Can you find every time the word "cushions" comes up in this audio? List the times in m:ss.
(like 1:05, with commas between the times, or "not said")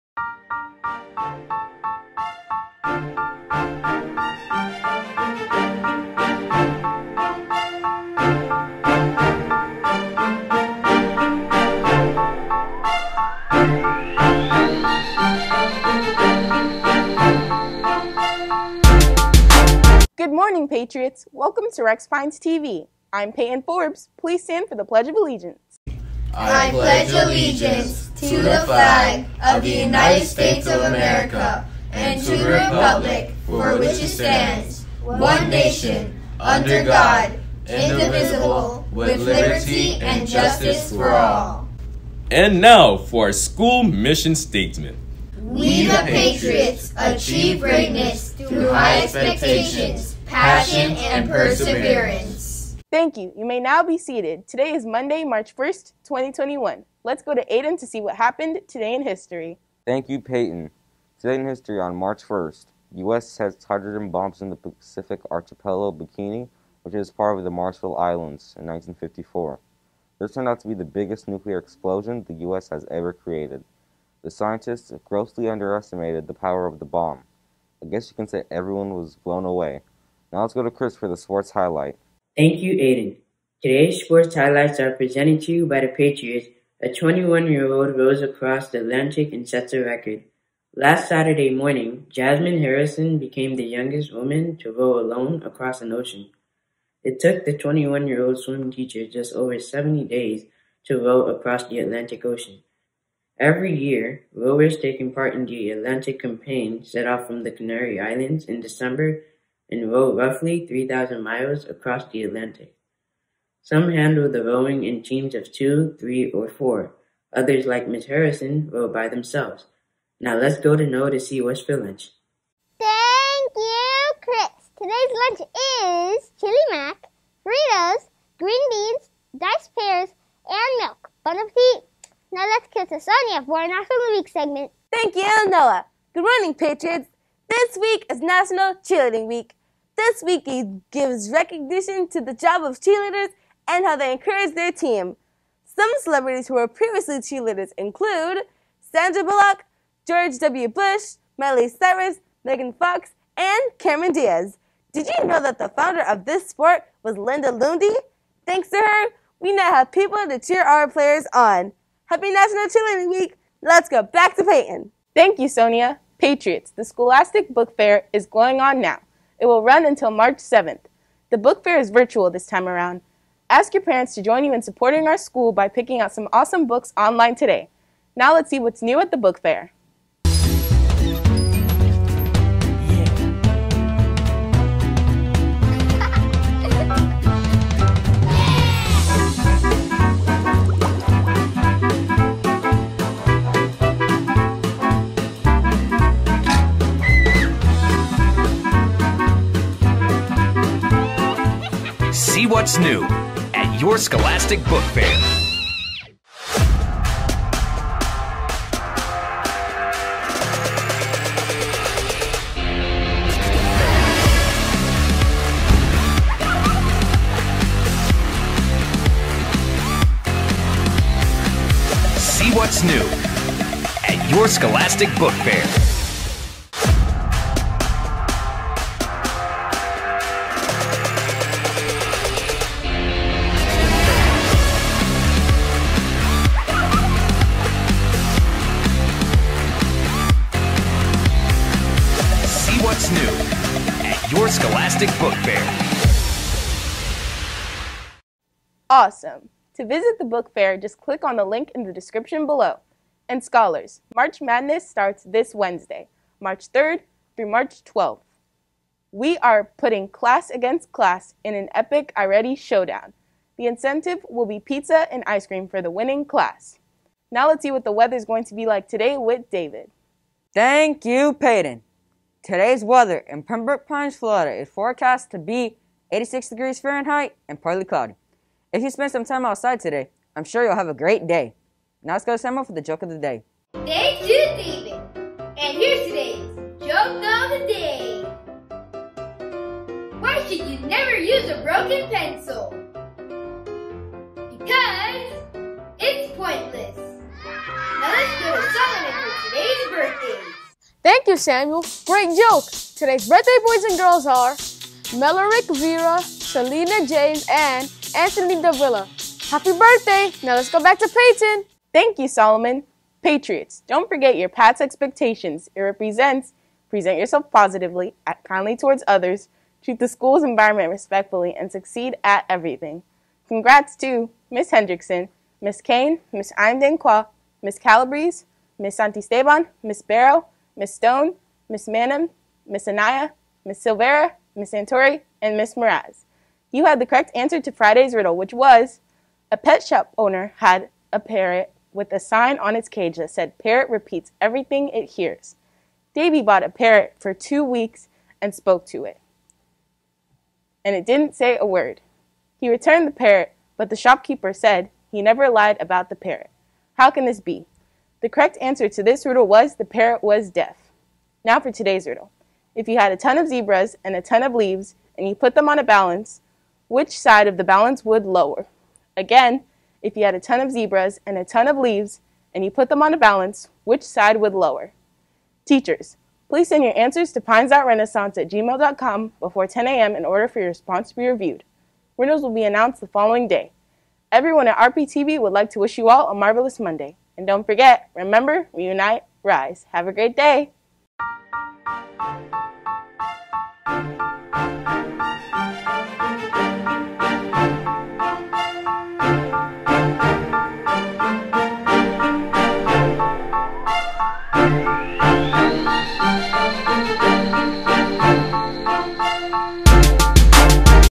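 not said.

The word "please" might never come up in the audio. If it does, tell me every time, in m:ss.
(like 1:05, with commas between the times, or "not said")
0:24, 6:16.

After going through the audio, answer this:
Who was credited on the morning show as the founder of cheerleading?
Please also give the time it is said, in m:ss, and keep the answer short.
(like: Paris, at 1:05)
Linda Lundy, at 2:37.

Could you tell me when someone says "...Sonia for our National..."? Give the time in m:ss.
2:12.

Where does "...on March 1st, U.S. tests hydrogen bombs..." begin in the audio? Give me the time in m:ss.
1:01.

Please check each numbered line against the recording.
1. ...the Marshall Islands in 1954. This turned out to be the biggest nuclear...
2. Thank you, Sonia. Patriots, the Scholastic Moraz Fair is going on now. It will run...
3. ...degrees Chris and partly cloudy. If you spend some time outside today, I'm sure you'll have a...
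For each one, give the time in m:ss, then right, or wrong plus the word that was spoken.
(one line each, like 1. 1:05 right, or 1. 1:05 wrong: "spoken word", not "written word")
1. 1:07 right
2. 2:45 wrong: "Book", not "Moraz"
3. 4:36 wrong: "Fahrenheit", not "Chris".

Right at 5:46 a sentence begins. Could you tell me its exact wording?
Davy bought a parrot for two weeks and spoke to it.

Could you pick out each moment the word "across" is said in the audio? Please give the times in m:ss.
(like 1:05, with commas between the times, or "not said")
1:28, 1:35, 1:41, 1:51.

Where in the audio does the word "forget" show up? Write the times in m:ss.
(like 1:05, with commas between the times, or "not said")
5:14, 6:27.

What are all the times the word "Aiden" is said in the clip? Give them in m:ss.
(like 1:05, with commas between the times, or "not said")
0:57, 1:22.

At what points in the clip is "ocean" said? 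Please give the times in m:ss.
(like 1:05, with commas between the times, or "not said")
1:35, 1:42.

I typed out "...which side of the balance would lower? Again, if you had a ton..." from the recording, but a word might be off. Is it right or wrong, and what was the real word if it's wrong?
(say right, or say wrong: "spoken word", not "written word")
right.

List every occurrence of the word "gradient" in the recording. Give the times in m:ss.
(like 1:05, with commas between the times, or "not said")
not said.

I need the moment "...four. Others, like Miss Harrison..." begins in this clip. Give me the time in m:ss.
1:56.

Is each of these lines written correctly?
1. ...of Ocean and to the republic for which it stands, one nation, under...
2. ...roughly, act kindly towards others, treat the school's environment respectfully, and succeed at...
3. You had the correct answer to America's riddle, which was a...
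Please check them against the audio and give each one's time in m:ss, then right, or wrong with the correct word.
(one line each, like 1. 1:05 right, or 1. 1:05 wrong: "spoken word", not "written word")
1. 0:30 wrong: "America", not "Ocean"
2. 5:17 wrong: "positively", not "roughly"
3. 5:36 wrong: "Friday", not "America".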